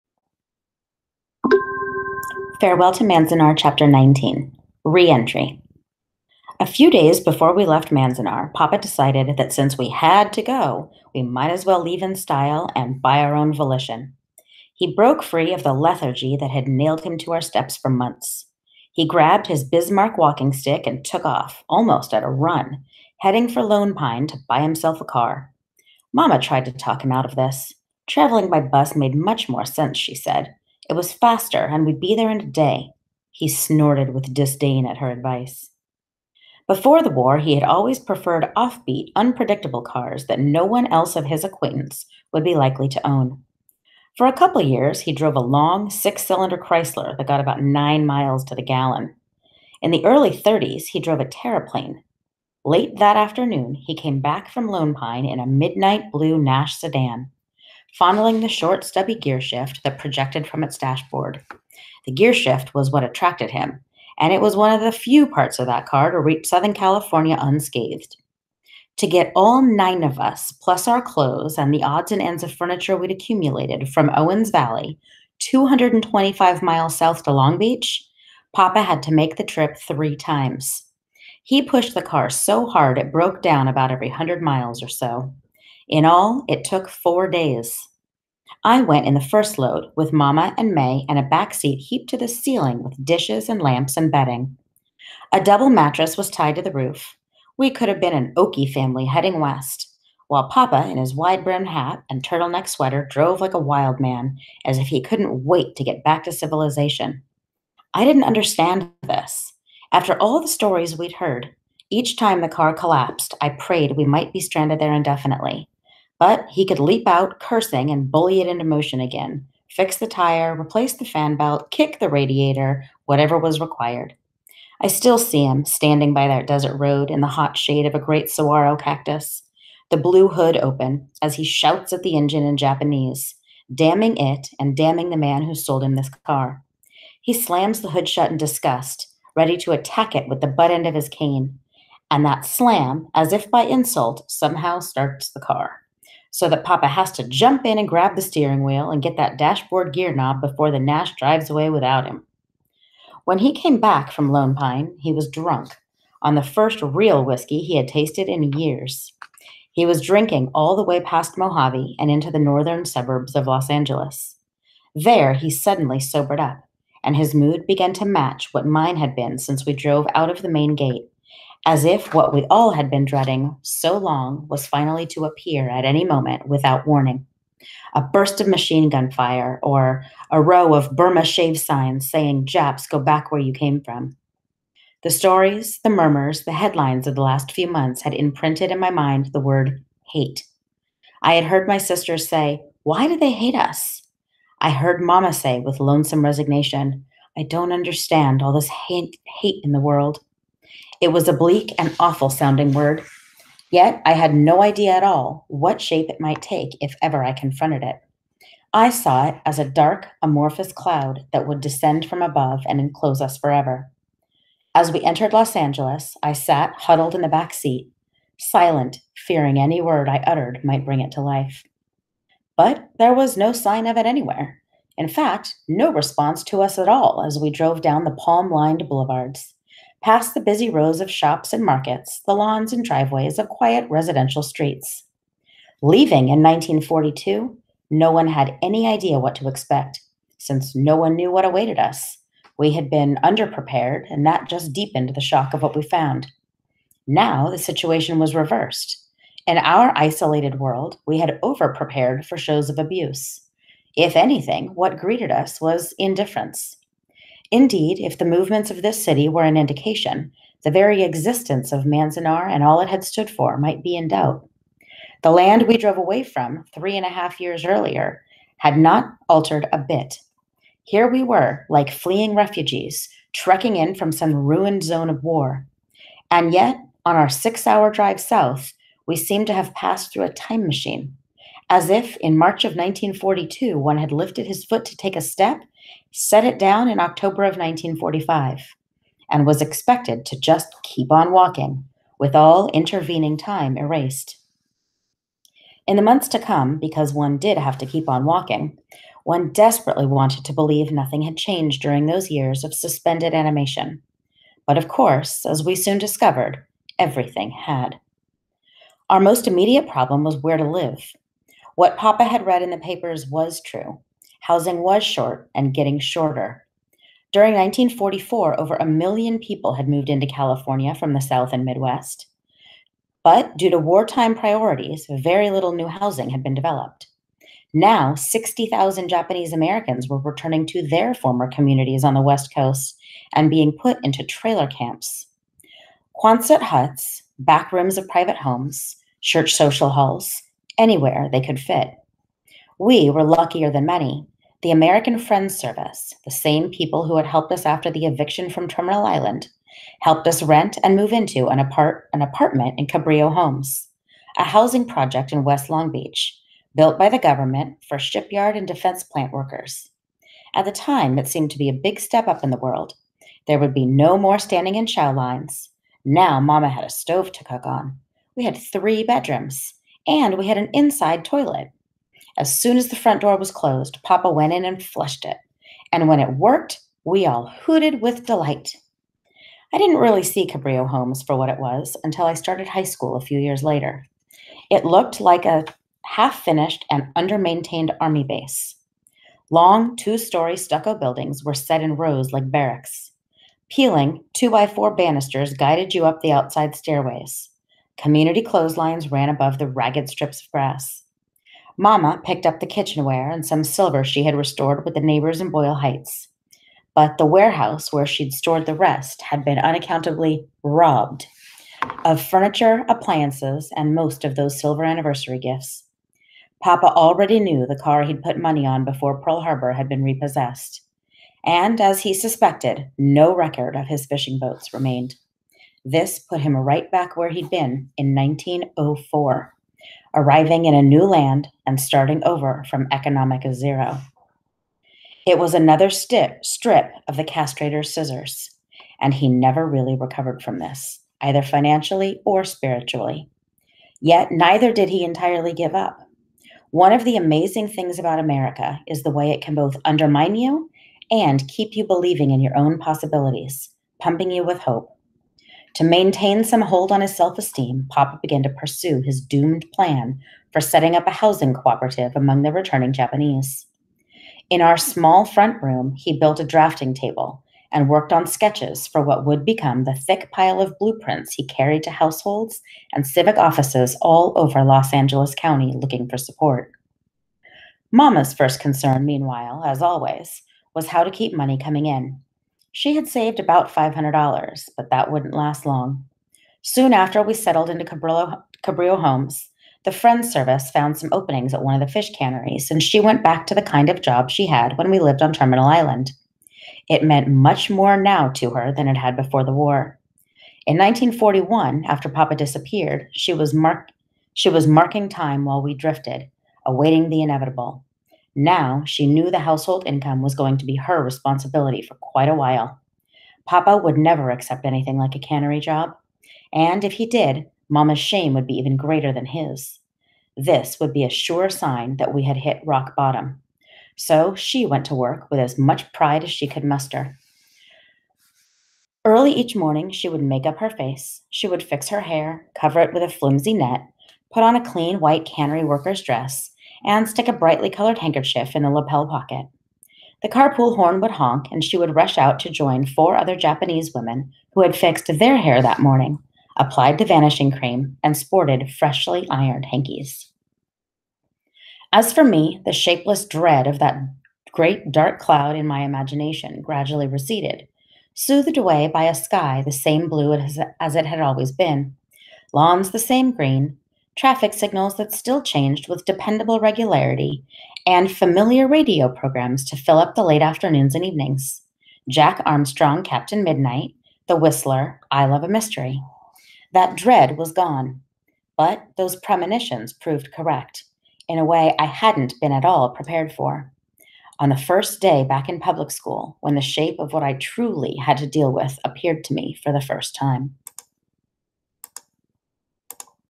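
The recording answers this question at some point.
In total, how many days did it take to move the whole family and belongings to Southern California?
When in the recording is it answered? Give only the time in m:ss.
1:26.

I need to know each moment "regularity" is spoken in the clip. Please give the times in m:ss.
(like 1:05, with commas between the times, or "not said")
9:26.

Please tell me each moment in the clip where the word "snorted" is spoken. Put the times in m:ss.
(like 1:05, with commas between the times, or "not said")
0:33.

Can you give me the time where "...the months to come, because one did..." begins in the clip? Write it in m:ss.
4:55.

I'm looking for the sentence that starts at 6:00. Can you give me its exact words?
At the time, it seemed to be a big step up in the world.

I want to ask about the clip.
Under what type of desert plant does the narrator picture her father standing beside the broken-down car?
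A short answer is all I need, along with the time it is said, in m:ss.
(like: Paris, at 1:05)
saguaro cactus, at 2:08.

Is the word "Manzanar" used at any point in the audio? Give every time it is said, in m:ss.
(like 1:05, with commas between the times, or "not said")
0:03, 0:07, 4:21.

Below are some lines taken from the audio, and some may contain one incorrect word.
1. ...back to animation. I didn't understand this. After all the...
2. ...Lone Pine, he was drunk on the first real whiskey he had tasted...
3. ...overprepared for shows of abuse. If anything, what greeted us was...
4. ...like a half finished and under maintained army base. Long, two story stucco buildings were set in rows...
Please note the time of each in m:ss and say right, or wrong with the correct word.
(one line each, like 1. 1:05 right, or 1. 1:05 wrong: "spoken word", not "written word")
1. 1:46 wrong: "civilization", not "animation"
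2. 2:34 right
3. 4:11 right
4. 6:25 right.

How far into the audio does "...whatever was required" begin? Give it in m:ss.
2:03.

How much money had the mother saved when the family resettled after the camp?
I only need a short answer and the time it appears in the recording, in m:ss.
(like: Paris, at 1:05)
$500, at 8:03.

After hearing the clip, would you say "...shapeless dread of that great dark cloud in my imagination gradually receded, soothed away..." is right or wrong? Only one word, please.
right.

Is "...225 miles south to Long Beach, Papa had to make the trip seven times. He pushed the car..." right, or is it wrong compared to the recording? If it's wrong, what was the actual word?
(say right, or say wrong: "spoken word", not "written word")
wrong: "three", not "seven".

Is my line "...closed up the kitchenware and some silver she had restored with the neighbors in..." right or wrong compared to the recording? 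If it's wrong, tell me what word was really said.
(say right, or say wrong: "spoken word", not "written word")
wrong: "picked", not "closed".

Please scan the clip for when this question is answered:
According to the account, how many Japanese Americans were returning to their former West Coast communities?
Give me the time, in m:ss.
5:28.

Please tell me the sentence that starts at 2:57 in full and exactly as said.
A burst of machine gun fire, or a row of Burma shave signs saying, Japs, go back where you came from.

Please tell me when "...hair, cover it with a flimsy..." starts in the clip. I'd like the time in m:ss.
8:52.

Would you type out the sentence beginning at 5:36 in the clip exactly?
Quonset huts, back rooms of private homes, church social halls, anywhere they could fit.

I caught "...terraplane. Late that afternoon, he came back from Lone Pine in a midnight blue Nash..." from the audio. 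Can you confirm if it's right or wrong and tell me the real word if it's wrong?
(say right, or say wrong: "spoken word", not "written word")
right.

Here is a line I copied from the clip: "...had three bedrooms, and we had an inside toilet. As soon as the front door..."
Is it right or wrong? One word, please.
right.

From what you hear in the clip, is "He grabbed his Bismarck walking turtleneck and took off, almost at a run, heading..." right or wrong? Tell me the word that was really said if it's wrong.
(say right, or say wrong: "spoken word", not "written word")
wrong: "stick", not "turtleneck".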